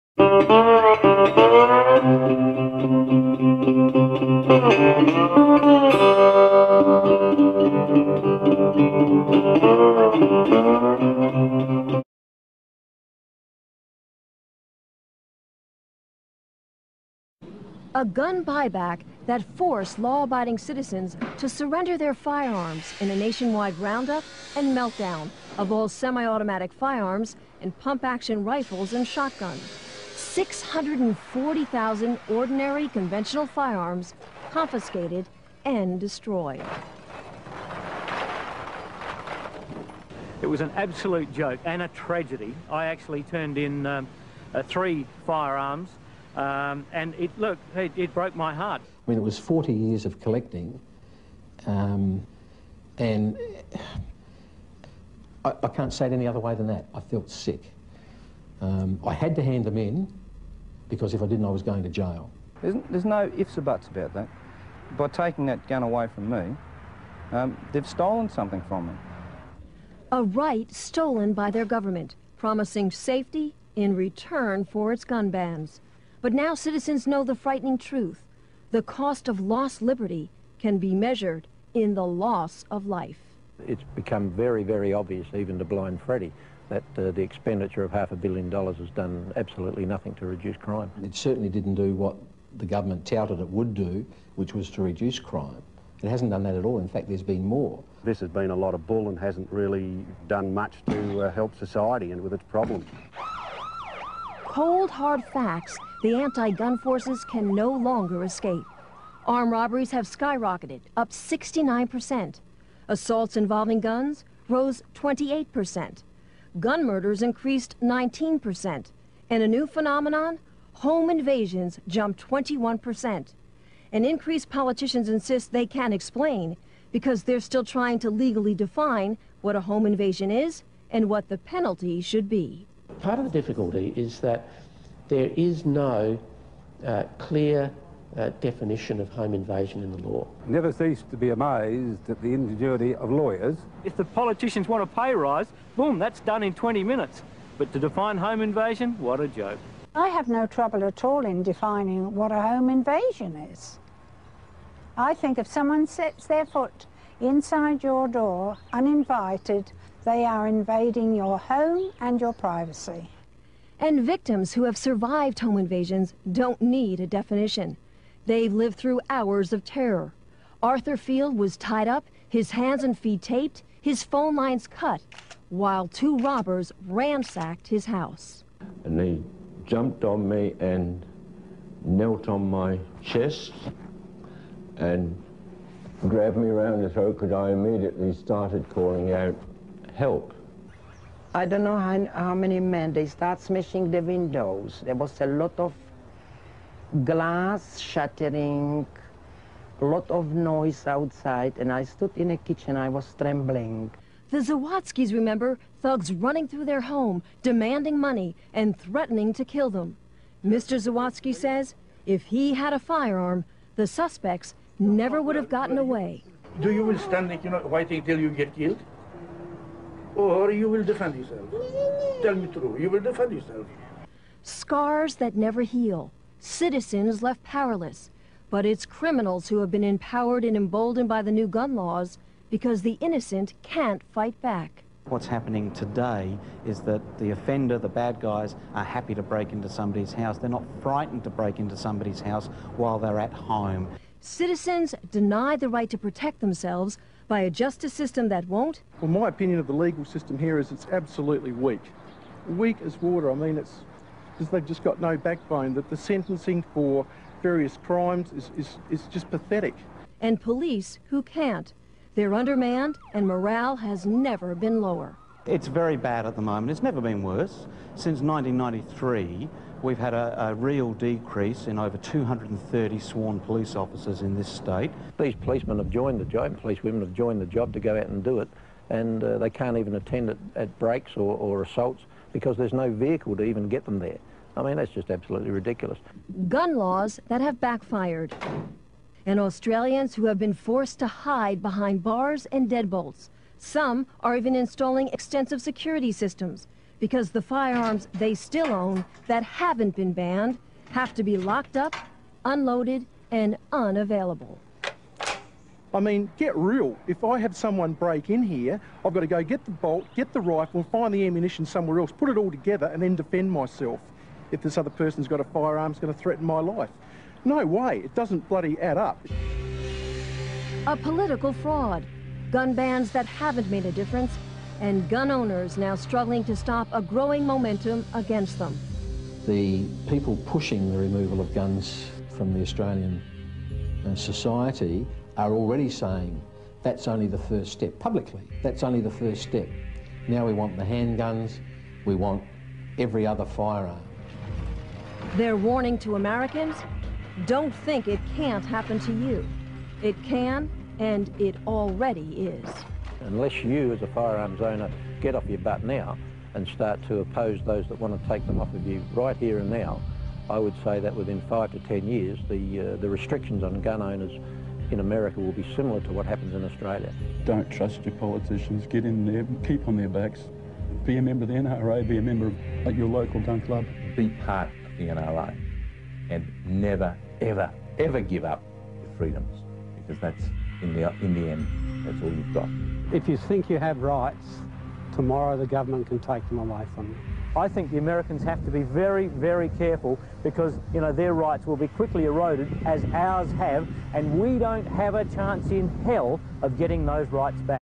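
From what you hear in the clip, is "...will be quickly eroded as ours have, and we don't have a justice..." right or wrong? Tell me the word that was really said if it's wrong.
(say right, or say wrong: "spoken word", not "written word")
wrong: "chance", not "justice".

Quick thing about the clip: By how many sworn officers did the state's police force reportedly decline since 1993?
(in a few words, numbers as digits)
230.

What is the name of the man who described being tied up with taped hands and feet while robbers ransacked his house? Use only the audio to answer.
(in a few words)
Arthur Field.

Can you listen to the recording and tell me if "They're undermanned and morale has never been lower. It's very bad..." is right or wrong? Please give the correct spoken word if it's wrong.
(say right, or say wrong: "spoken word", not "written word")
right.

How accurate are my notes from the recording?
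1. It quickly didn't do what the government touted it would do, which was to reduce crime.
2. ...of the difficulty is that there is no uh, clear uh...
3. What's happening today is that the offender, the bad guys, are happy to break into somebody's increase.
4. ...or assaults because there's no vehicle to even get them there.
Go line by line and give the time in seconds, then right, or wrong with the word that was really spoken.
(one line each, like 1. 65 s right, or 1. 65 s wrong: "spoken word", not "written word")
1. 91 s wrong: "certainly", not "quickly"
2. 133 s right
3. 235 s wrong: "house", not "increase"
4. 281 s right.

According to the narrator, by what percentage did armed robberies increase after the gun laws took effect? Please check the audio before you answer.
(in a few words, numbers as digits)
69%.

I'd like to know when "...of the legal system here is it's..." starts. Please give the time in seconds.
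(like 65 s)
249 s.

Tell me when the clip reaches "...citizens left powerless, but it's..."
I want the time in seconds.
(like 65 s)
226 s.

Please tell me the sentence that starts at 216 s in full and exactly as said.
Do you will stand like, you know, waiting till you get killed?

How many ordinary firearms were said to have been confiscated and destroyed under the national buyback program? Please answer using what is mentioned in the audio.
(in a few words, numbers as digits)
640,000.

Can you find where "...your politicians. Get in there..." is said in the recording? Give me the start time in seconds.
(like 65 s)
368 s.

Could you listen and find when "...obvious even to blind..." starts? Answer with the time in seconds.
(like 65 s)
84 s.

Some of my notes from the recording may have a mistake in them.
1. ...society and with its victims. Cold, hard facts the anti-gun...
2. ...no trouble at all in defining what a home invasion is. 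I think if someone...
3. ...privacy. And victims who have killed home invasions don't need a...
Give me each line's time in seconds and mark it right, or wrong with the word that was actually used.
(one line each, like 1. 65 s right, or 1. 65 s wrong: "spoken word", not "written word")
1. 101 s wrong: "problems", not "victims"
2. 150 s right
3. 162 s wrong: "survived", not "killed".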